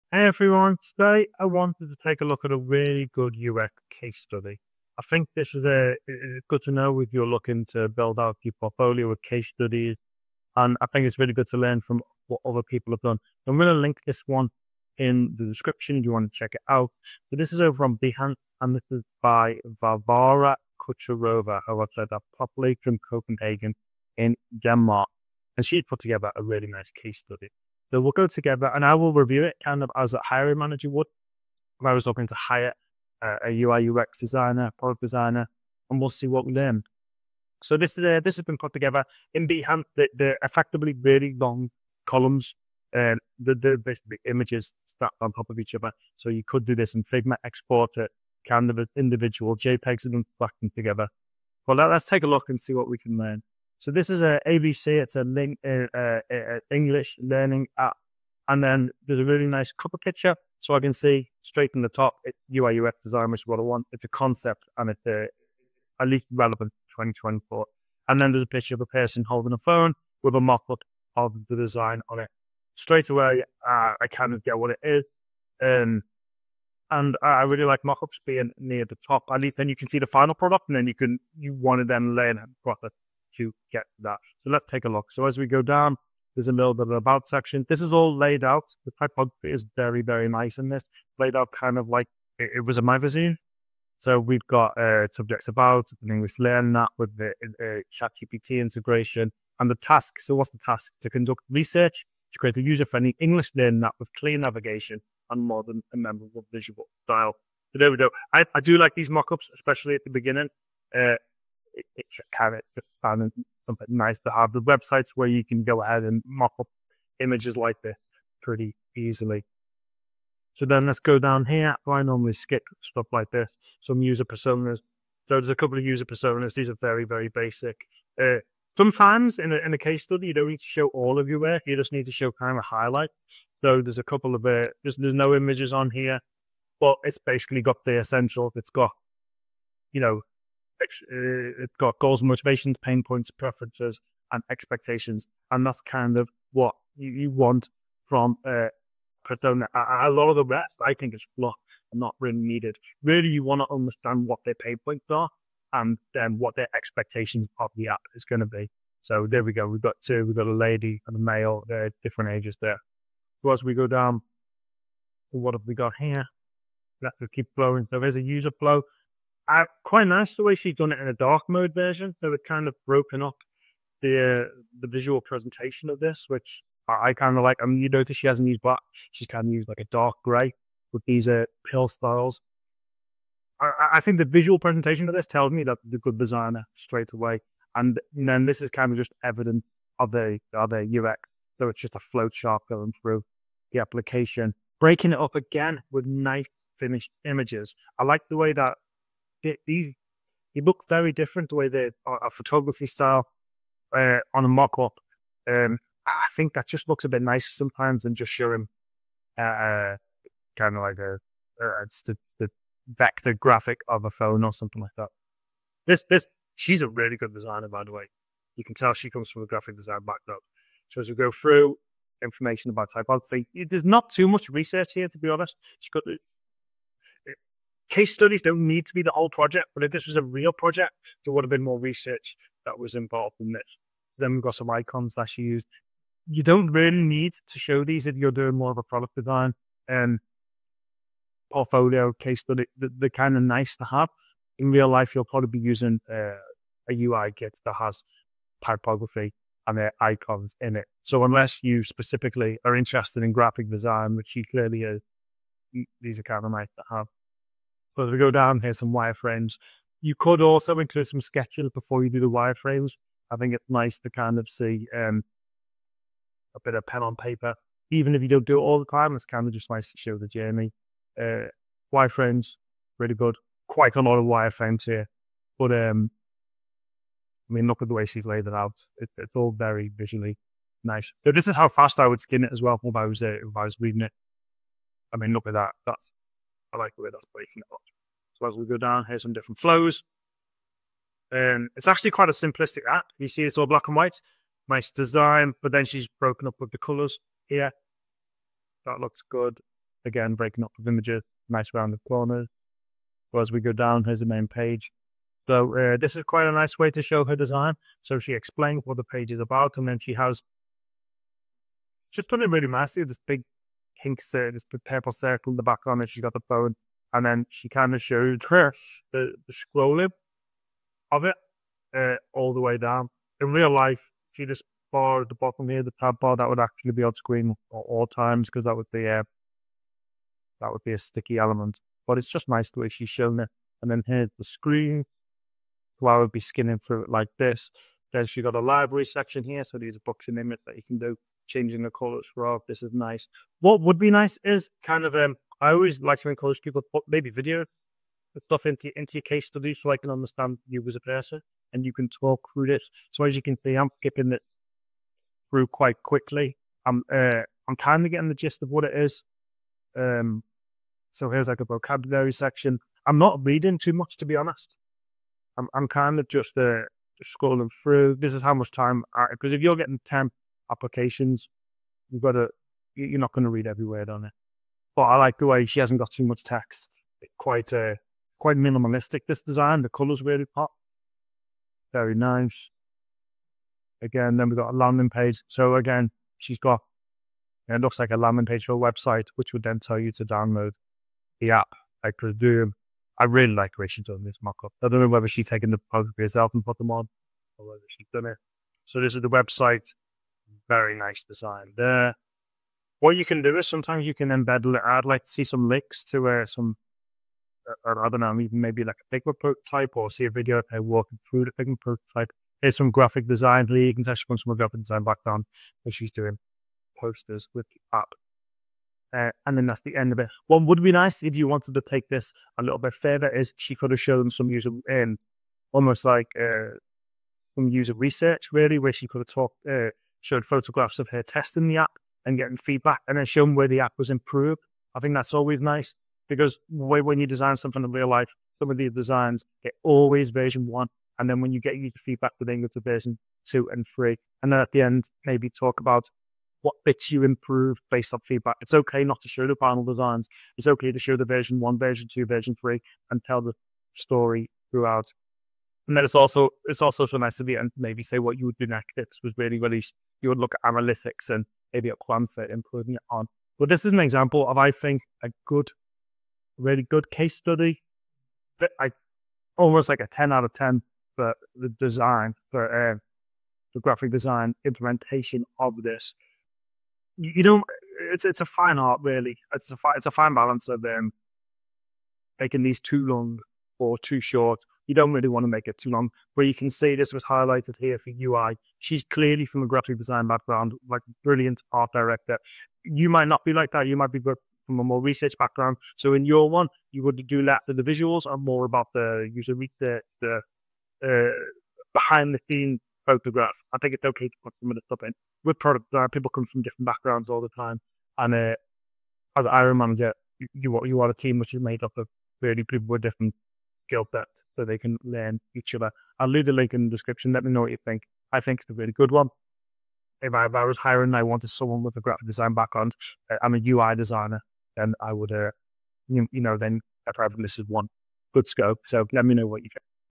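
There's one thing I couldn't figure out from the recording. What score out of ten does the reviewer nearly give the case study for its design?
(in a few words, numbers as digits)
10.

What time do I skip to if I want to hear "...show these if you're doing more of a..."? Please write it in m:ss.
3:57.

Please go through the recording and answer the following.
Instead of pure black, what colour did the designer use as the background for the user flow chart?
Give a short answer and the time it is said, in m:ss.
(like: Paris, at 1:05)
dark grey, at 2:59.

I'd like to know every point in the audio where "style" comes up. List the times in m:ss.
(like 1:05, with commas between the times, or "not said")
1:47, 3:01, 3:22.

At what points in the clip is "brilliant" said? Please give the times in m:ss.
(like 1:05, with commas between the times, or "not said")
8:11.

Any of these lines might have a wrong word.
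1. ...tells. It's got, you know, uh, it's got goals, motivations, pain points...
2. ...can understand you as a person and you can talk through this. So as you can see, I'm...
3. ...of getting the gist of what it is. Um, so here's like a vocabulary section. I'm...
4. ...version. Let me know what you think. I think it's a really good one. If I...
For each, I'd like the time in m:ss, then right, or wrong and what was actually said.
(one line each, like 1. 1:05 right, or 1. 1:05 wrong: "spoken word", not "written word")
1. 2:17 wrong: "essentials", not "tells"
2. 5:49 right
3. 5:58 right
4. 8:36 wrong: "description", not "version".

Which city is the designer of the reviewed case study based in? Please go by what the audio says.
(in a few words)
Copenhagen.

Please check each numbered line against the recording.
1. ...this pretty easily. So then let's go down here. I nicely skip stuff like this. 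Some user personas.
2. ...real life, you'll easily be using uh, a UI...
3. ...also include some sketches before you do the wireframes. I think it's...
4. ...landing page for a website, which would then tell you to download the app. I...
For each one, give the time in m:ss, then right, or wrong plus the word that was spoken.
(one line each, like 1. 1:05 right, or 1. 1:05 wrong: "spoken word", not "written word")
1. 1:57 wrong: "normally", not "nicely"
2. 4:04 wrong: "probably", not "easily"
3. 4:20 right
4. 6:28 right.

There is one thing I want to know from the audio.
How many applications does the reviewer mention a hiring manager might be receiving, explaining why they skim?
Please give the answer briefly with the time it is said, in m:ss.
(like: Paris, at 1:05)
10, at 6:10.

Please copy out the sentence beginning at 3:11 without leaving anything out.
So it's just a flowchart going through the application, breaking it up again with nice finished images.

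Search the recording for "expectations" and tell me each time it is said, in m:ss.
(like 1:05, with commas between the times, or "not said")
2:24, 2:36.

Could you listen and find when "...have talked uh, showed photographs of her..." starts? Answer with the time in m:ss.
7:09.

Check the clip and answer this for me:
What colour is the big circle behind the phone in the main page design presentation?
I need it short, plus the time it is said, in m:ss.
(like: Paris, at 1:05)
pink, at 5:14.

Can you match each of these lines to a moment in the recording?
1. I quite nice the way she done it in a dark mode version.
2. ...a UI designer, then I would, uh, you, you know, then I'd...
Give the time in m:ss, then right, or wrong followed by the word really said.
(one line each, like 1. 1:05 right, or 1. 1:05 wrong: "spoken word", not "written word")
1. 2:49 right
2. 8:43 right.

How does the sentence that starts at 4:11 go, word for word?
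So unless you specifically are interested in graphic design, which she clearly is, these are kind of nice to have.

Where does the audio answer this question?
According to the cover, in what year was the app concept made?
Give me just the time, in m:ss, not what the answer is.
1:06.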